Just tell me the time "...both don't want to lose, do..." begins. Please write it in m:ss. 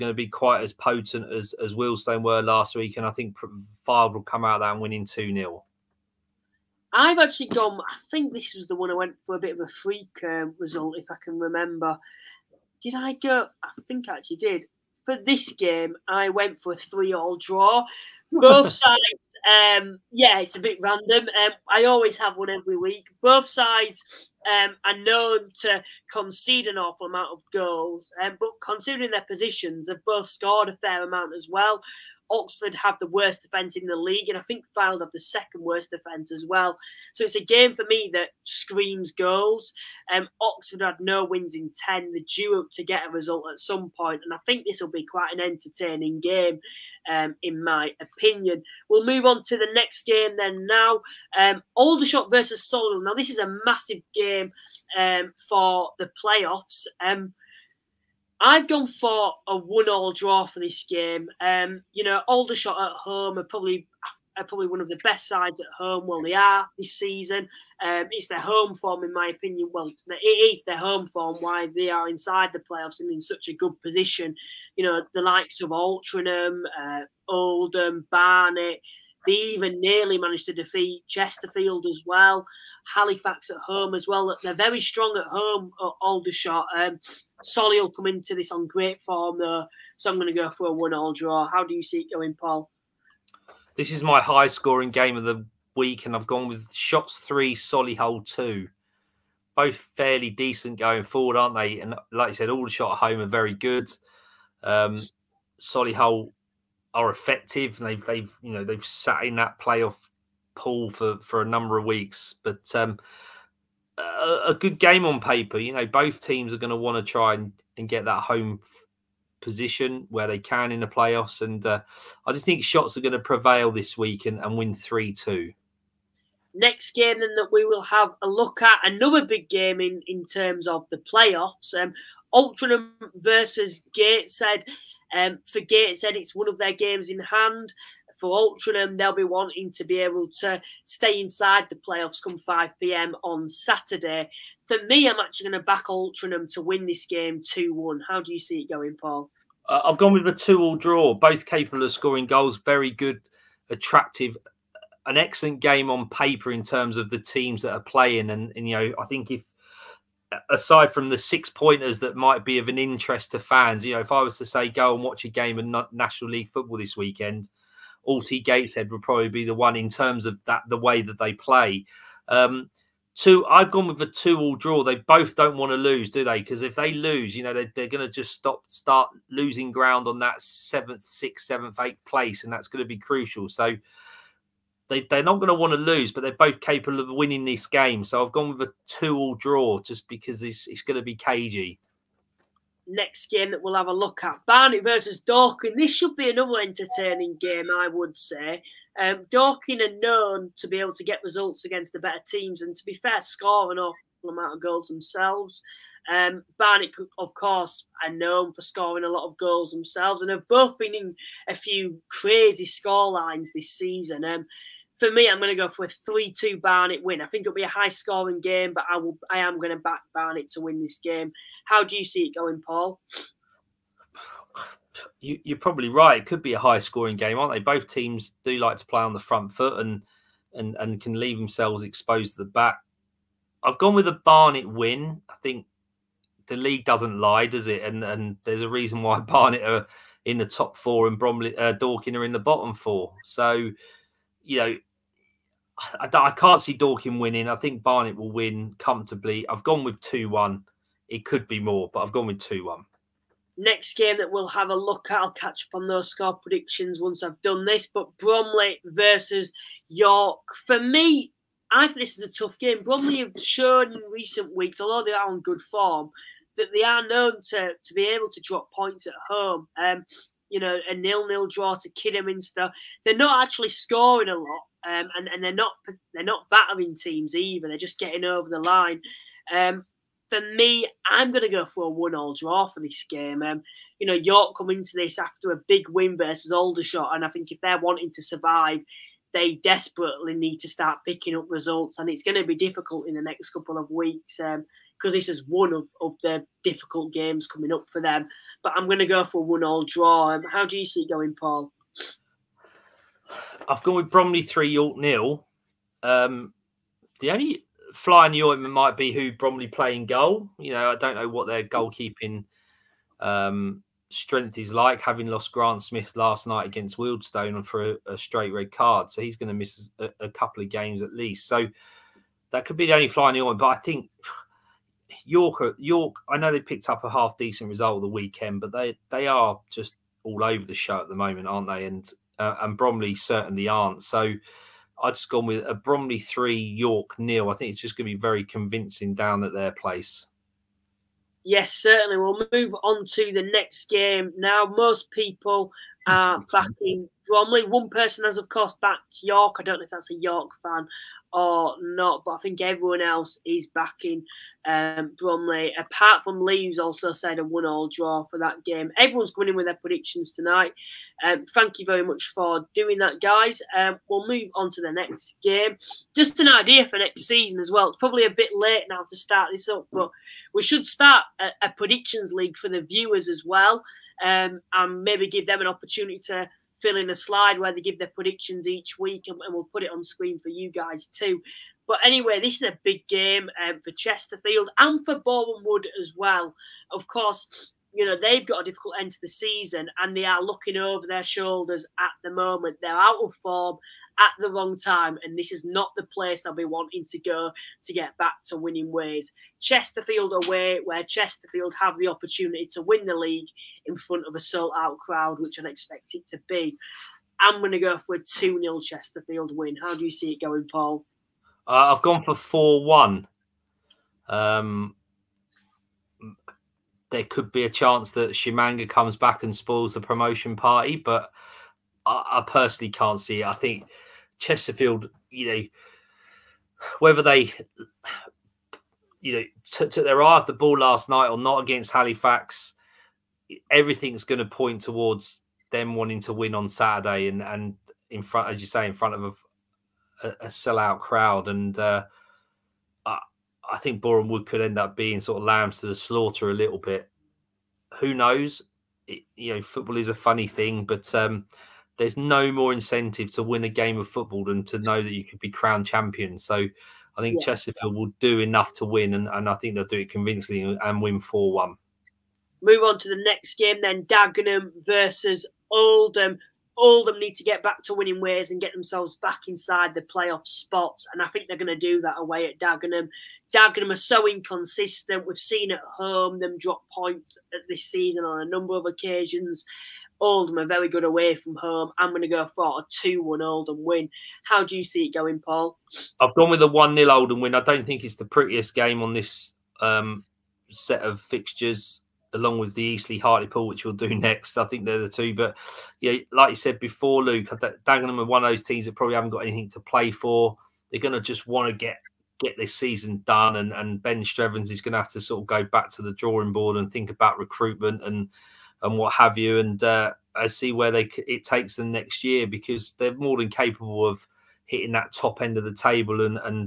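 2:54.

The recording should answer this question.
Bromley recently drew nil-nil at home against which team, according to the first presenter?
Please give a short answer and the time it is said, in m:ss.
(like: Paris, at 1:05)
Kidderminster, at 4:31.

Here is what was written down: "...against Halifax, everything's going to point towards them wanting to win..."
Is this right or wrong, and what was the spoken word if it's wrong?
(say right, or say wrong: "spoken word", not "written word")
right.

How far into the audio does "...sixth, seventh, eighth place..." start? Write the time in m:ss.
3:01.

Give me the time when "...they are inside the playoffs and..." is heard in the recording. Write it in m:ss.
1:11.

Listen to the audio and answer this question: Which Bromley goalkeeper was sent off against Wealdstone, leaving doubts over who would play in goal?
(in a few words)
Grant Smith.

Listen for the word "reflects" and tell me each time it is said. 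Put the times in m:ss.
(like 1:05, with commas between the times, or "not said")
not said.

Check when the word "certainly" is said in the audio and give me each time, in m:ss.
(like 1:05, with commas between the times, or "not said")
5:33, 5:41.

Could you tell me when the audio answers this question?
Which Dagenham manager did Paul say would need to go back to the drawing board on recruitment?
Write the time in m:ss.
8:24.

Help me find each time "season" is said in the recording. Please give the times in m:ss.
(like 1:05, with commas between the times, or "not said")
1:06, 3:33, 6:07, 6:29, 7:57, 8:22.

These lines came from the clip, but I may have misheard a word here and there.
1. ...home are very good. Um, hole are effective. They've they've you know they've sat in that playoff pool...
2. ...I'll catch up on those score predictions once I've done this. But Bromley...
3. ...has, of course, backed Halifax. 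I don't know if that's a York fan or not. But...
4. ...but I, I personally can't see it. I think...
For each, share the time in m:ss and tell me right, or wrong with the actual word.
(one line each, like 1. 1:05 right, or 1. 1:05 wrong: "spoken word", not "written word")
1. 1:42 right
2. 4:15 right
3. 5:48 wrong: "York", not "Halifax"
4. 7:00 right.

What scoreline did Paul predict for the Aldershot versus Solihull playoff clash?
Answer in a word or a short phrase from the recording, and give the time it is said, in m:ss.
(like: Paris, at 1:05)
3-2 to Aldershot, at 1:36.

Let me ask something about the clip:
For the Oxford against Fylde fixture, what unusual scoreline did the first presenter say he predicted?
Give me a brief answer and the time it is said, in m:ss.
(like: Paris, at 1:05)
3-3 draw, at 0:16.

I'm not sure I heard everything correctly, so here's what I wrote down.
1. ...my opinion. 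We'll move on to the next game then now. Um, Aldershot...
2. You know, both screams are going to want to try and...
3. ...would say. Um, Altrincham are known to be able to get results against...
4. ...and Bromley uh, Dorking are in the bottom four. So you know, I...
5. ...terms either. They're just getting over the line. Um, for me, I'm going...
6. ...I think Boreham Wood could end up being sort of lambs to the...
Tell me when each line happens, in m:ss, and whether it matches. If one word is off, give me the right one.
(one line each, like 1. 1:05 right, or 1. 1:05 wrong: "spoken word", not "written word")
1. 0:47 right
2. 1:55 wrong: "teams", not "screams"
3. 3:17 wrong: "Dorking", not "Altrincham"
4. 4:01 right
5. 4:36 wrong: "teams", not "terms"
6. 7:23 right.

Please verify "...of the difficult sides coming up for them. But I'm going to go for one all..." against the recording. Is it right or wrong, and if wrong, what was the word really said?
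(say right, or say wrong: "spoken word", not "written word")
wrong: "games", not "sides".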